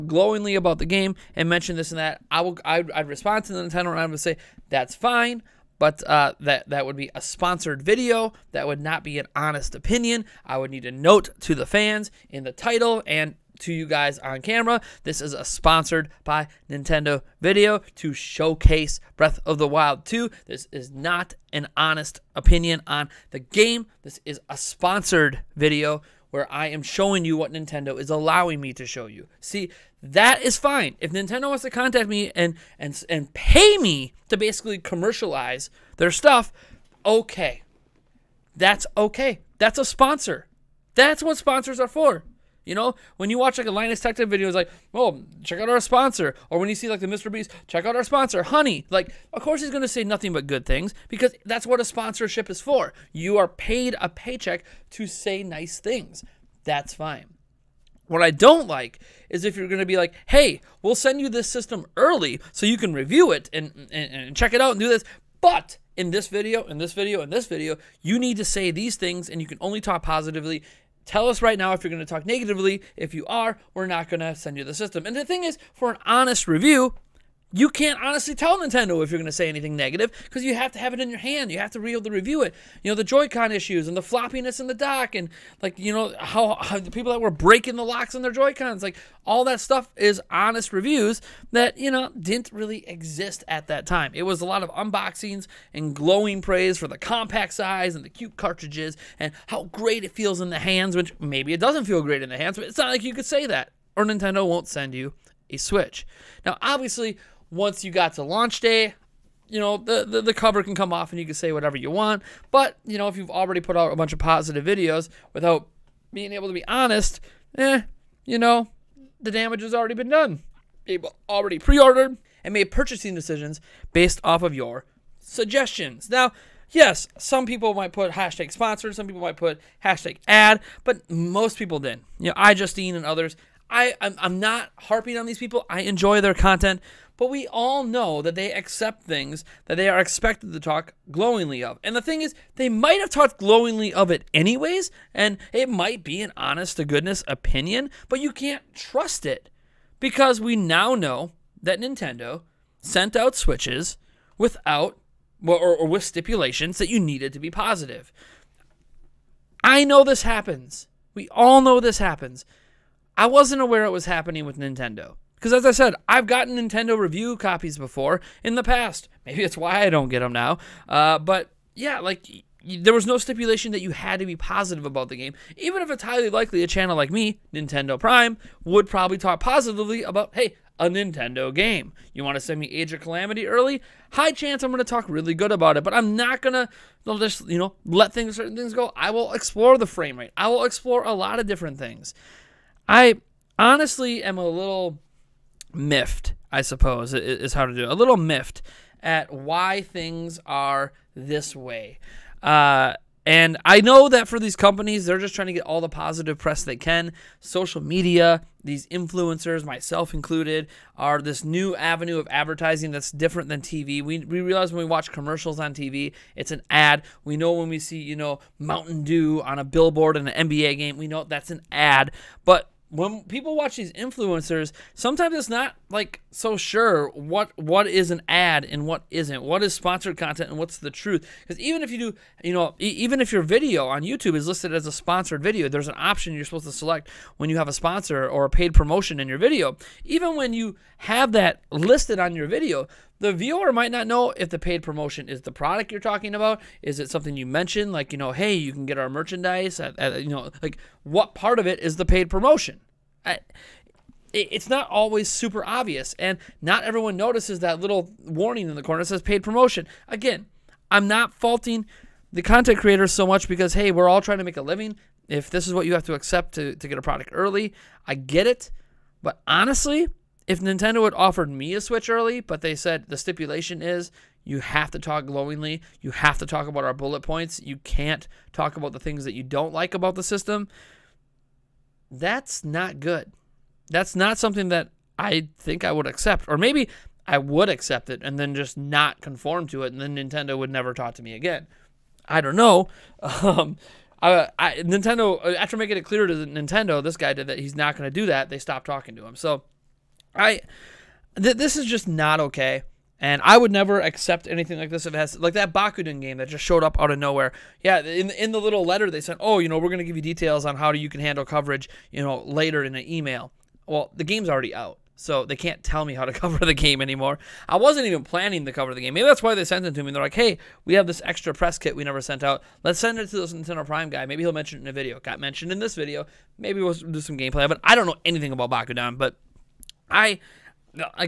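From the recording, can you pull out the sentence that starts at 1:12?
If you are, we're not going to send you the system.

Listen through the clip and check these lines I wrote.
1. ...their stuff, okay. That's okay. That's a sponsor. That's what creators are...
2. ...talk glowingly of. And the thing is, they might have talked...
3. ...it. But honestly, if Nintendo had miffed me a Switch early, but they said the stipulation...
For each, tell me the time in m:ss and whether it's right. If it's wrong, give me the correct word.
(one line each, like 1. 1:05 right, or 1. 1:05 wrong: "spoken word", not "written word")
1. 0:35 wrong: "sponsors", not "creators"
2. 2:20 right
3. 4:28 wrong: "offered", not "miffed".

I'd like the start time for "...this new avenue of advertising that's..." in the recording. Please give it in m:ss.
3:31.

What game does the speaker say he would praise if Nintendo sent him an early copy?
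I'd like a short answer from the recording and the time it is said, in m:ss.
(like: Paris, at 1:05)
Age of Calamity, at 3:02.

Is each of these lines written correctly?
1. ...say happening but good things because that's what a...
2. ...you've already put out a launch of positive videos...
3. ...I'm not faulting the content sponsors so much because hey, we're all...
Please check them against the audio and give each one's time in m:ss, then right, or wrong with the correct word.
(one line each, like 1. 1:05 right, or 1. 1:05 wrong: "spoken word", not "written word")
1. 0:49 wrong: "nothing", not "happening"
2. 1:53 wrong: "bunch", not "launch"
3. 4:20 wrong: "creators", not "sponsors".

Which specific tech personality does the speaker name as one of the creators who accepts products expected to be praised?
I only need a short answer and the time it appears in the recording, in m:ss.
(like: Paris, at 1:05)
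iJustine, at 2:12.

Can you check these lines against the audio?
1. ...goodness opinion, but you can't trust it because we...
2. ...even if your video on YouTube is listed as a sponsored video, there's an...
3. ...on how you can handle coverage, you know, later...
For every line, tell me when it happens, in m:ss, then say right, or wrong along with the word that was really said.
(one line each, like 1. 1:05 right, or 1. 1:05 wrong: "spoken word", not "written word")
1. 2:26 right
2. 3:52 right
3. 5:10 right.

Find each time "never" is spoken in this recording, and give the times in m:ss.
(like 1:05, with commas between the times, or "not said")
4:50, 5:03, 5:22.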